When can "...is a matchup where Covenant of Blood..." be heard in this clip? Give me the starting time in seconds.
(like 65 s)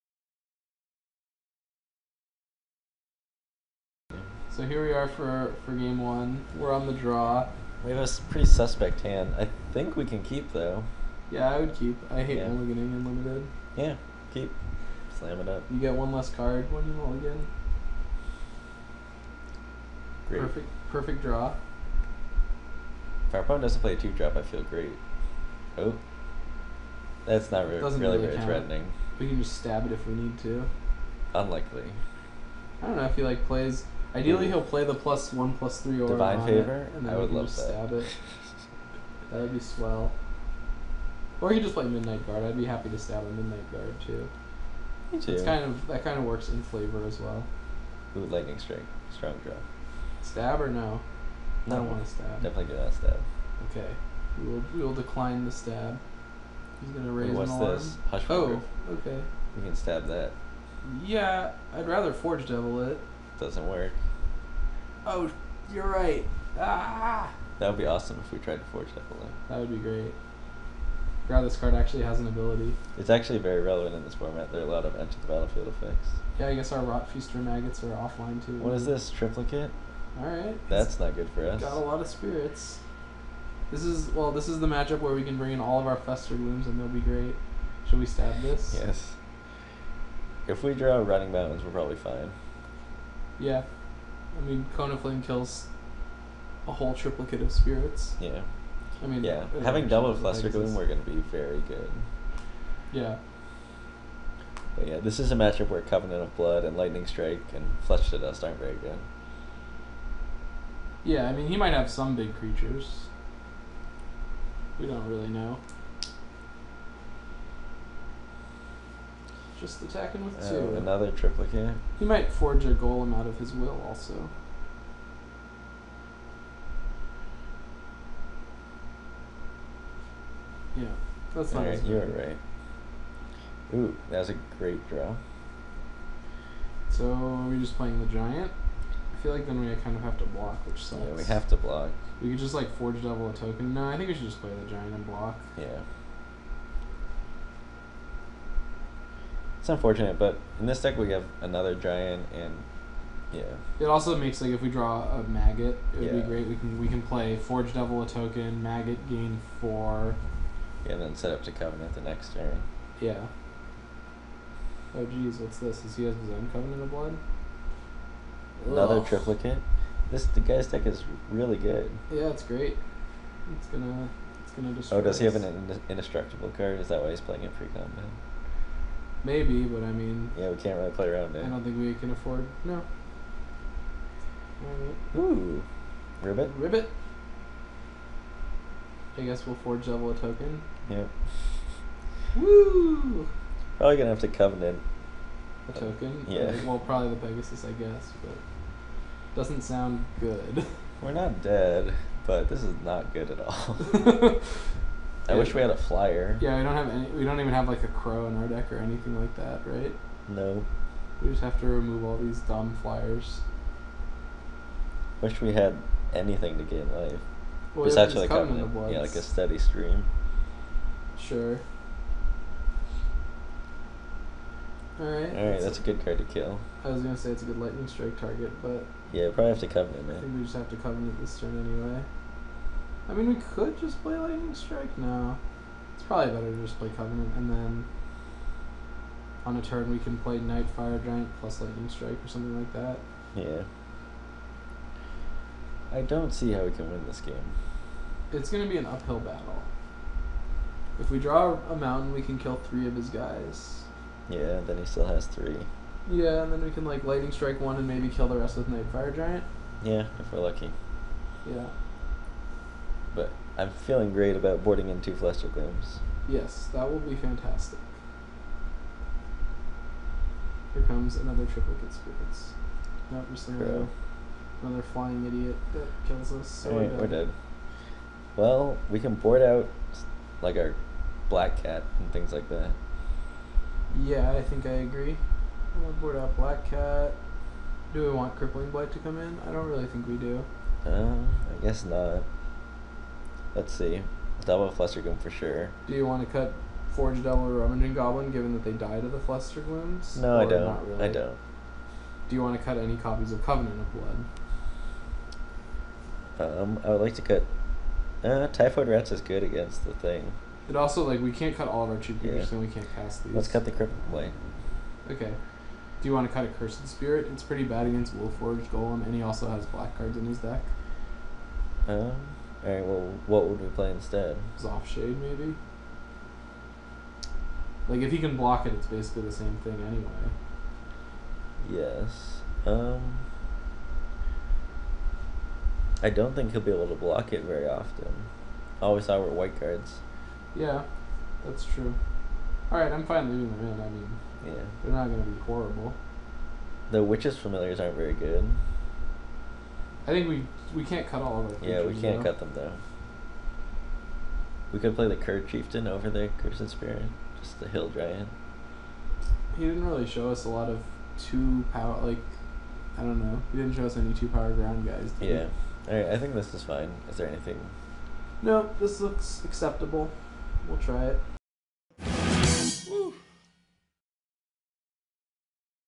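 105 s.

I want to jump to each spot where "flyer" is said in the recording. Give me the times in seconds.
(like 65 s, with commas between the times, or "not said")
205 s, 212 s.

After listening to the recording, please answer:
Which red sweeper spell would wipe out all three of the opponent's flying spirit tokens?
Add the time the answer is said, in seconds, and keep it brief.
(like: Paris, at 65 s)
Cone of Flame, at 94 s.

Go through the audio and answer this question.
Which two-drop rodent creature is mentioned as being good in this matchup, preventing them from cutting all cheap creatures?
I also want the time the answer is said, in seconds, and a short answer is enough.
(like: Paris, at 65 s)
Typhoid Rats, at 308 s.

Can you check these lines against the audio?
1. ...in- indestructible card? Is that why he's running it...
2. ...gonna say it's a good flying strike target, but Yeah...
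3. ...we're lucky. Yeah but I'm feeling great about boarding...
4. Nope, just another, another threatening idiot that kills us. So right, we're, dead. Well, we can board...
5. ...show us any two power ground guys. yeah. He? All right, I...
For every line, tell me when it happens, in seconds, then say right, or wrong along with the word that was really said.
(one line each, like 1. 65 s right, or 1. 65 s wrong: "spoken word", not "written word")
1. 175 s wrong: "playing", not "running"
2. 227 s wrong: "lightning", not "flying"
3. 260 s right
4. 273 s wrong: "flying", not "threatening"
5. 363 s right.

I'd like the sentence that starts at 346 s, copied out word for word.
The witches familiars aren't very good.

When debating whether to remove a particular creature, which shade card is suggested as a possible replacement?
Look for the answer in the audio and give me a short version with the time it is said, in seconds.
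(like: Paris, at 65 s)
Soft Shade, at 324 s.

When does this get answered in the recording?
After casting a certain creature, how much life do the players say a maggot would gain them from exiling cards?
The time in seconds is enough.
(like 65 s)
159 s.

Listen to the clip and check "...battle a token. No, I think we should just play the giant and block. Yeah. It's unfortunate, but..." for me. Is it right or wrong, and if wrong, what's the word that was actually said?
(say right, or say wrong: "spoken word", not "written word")
wrong: "double", not "battle".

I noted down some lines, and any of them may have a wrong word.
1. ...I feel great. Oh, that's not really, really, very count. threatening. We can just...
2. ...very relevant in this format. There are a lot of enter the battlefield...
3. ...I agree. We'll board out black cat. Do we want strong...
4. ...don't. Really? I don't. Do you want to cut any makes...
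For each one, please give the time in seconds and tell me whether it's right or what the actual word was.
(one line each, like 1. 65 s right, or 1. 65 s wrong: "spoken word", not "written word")
1. 24 s right
2. 73 s right
3. 284 s wrong: "crippling", not "strong"
4. 300 s wrong: "copies", not "makes".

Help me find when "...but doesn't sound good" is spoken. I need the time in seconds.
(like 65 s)
198 s.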